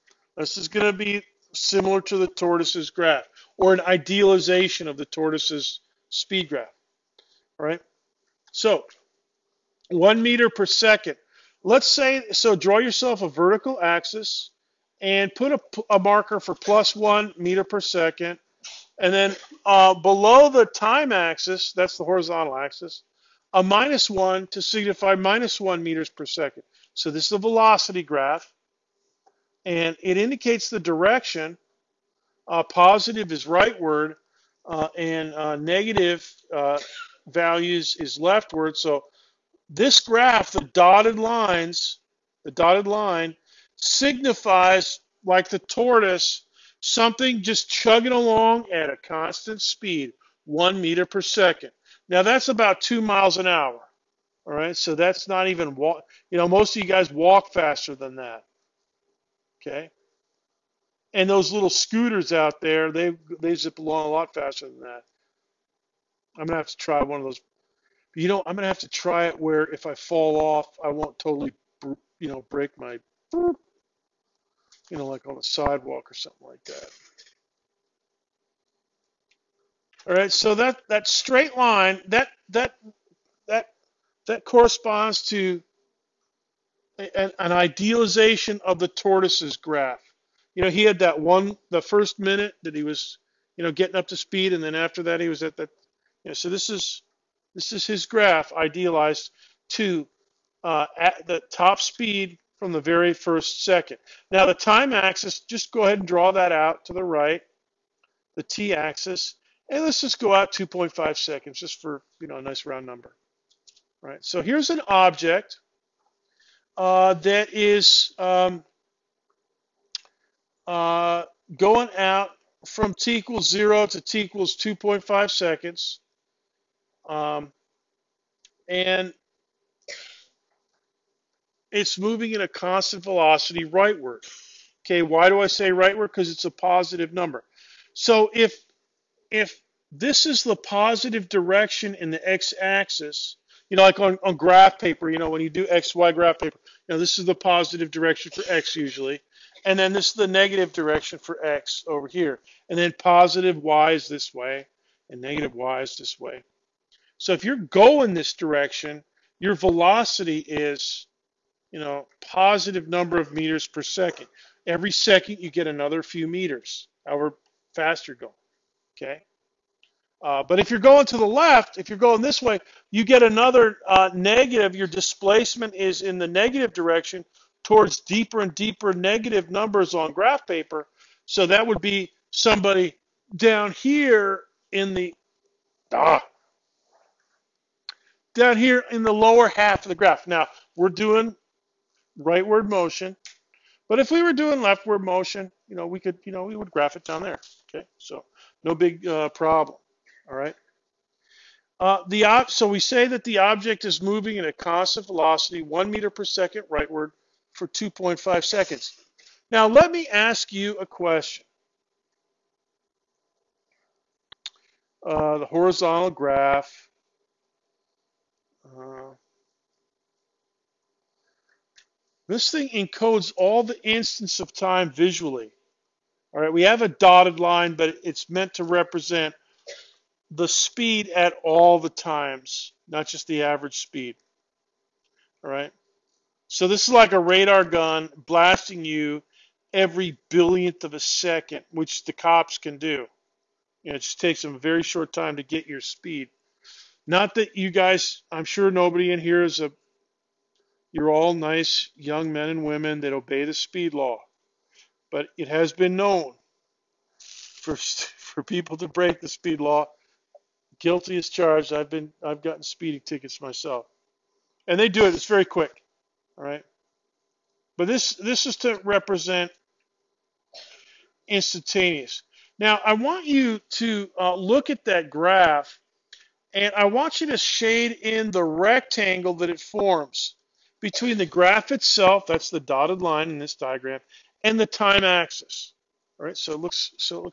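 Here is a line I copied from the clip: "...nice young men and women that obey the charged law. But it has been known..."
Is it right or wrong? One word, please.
wrong.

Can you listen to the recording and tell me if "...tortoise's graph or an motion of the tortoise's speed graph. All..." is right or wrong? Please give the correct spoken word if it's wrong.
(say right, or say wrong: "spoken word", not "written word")
wrong: "idealization", not "motion".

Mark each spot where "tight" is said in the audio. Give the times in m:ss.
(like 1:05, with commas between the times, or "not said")
not said.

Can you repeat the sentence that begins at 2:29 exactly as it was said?
And then this is the negative direction for X over here.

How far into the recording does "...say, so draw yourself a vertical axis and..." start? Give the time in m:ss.
0:11.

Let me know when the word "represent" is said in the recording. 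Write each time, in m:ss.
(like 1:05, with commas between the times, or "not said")
3:48, 4:28.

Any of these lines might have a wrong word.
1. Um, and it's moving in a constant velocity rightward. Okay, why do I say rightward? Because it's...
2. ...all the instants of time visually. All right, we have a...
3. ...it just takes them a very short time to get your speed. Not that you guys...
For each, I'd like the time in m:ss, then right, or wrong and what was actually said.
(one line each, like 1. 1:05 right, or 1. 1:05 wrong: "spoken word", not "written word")
1. 2:07 right
2. 3:43 right
3. 4:03 right.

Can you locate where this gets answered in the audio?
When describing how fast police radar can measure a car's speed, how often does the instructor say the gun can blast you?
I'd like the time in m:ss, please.
3:59.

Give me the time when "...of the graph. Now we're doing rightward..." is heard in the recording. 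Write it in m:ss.
3:09.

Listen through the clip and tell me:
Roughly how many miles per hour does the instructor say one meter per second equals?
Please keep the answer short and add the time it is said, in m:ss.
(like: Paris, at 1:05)
2 miles an hour, at 0:52.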